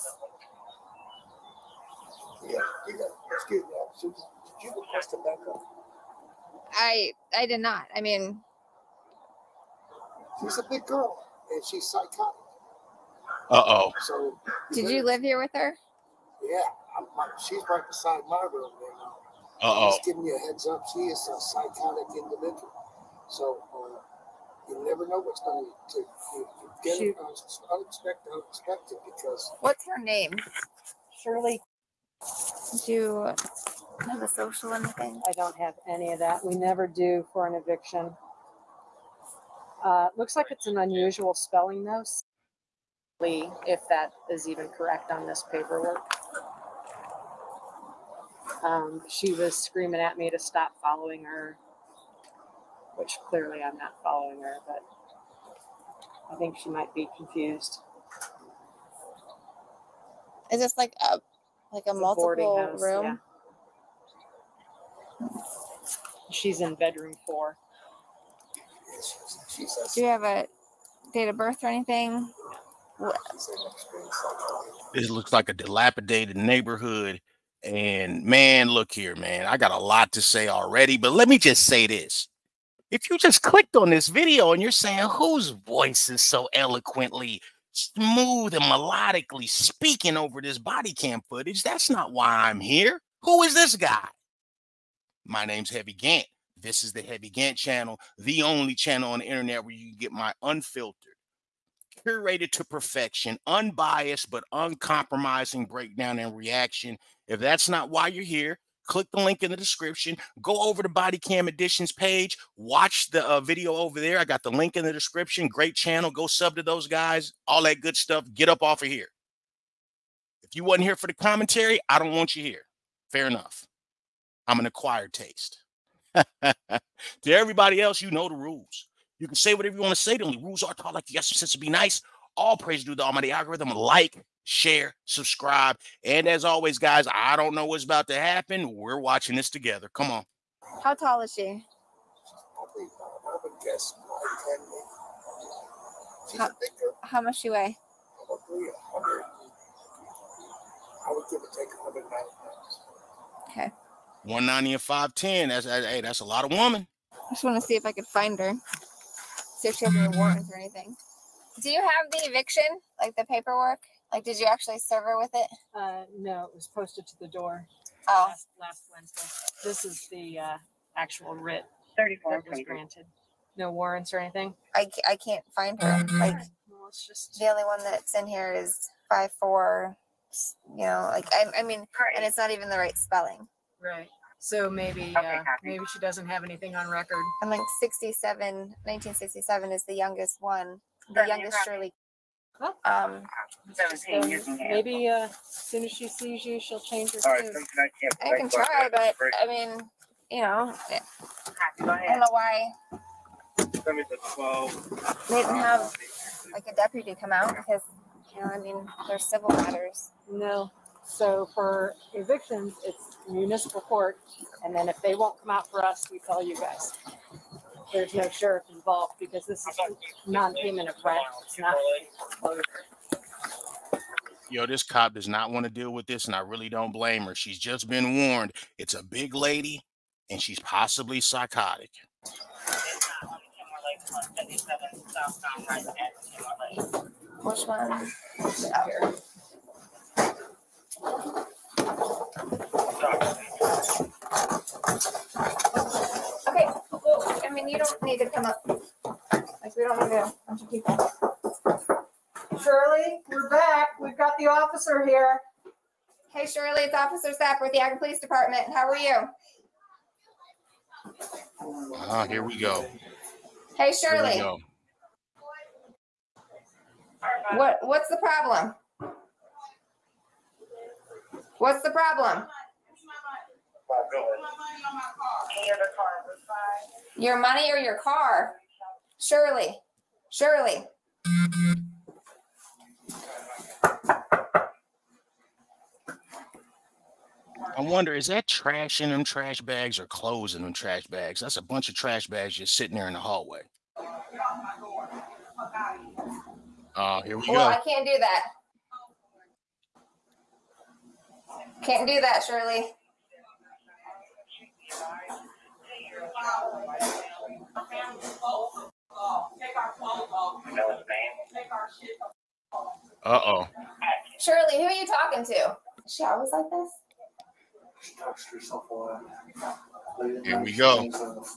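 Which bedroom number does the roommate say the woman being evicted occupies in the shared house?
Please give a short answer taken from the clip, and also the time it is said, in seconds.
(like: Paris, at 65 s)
4, at 66 s.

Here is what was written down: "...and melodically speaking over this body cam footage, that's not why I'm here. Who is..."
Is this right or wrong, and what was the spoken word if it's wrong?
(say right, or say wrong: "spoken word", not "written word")
right.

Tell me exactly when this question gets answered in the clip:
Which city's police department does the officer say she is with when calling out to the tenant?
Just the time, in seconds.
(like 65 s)
257 s.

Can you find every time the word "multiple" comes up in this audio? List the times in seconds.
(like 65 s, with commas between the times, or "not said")
61 s.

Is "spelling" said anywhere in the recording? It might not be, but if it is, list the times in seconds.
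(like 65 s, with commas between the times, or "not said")
41 s, 182 s.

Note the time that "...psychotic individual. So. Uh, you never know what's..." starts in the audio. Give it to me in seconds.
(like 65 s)
21 s.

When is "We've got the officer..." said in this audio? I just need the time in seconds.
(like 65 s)
253 s.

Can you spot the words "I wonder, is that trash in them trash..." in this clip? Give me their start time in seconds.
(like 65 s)
287 s.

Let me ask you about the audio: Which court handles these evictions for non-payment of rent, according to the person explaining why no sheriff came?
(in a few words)
Municipal court.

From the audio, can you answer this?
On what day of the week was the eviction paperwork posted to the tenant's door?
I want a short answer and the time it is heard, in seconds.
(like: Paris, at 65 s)
Wednesday, at 168 s.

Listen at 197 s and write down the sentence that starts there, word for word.
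I can I can try, but I mean, you know, Go I don't know why Send me the twelve.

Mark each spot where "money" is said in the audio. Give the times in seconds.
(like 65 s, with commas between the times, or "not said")
277 s.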